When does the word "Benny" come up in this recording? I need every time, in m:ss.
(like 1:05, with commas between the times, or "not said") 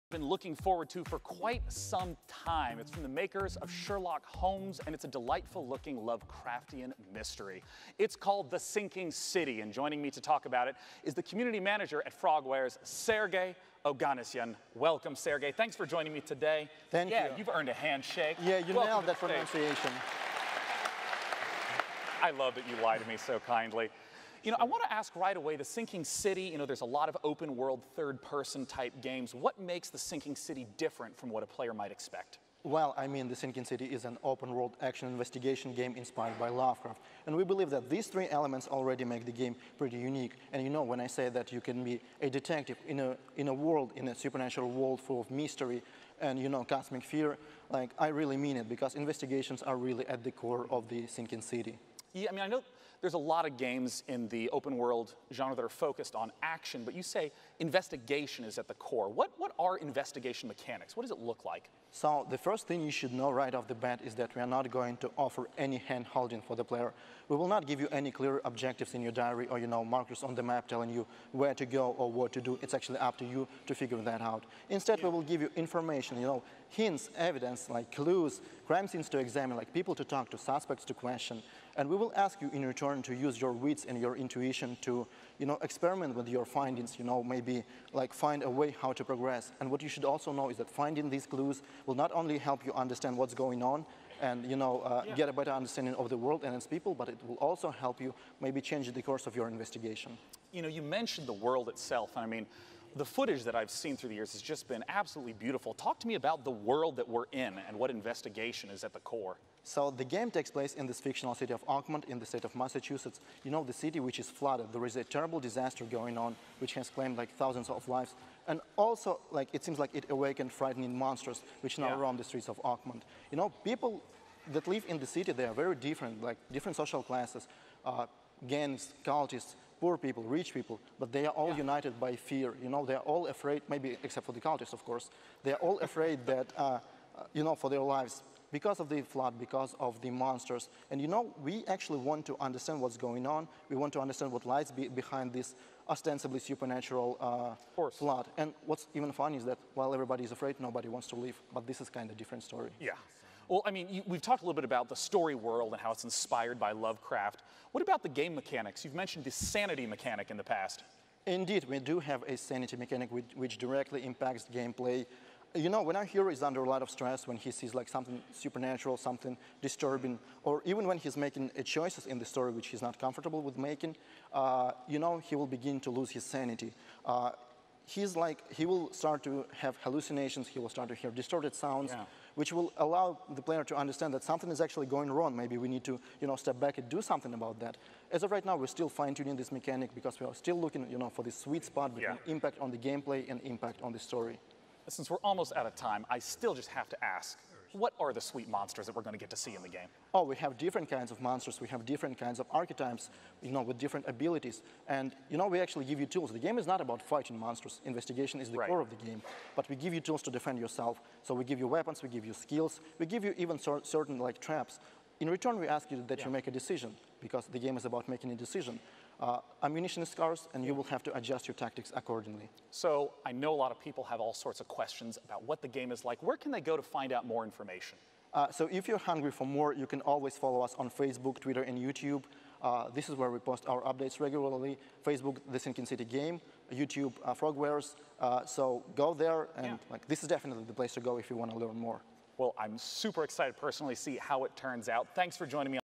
not said.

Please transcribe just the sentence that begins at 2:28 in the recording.
And what's even funny is that while everybody is afraid, nobody wants to leave.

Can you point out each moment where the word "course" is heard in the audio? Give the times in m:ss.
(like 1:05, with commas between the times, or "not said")
1:39, 2:14.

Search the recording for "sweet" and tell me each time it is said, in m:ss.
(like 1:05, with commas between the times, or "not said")
3:11, 3:18.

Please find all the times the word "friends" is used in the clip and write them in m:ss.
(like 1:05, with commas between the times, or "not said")
not said.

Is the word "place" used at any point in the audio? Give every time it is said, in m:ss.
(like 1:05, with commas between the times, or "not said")
1:50, 4:00.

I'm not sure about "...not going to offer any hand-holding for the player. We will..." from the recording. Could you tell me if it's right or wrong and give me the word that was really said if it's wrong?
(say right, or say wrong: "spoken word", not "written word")
right.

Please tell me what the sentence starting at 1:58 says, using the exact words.
And also, like, it seems like it awakened frightening monsters which now yeah.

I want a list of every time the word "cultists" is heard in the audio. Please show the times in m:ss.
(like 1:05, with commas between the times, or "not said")
2:09, 2:14.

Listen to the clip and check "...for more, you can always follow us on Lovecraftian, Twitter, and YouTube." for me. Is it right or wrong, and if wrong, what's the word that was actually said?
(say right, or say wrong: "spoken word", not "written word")
wrong: "Facebook", not "Lovecraftian".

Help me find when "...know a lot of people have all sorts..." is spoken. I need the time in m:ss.
3:43.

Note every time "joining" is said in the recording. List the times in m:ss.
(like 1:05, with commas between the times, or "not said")
0:09, 0:15, 4:05.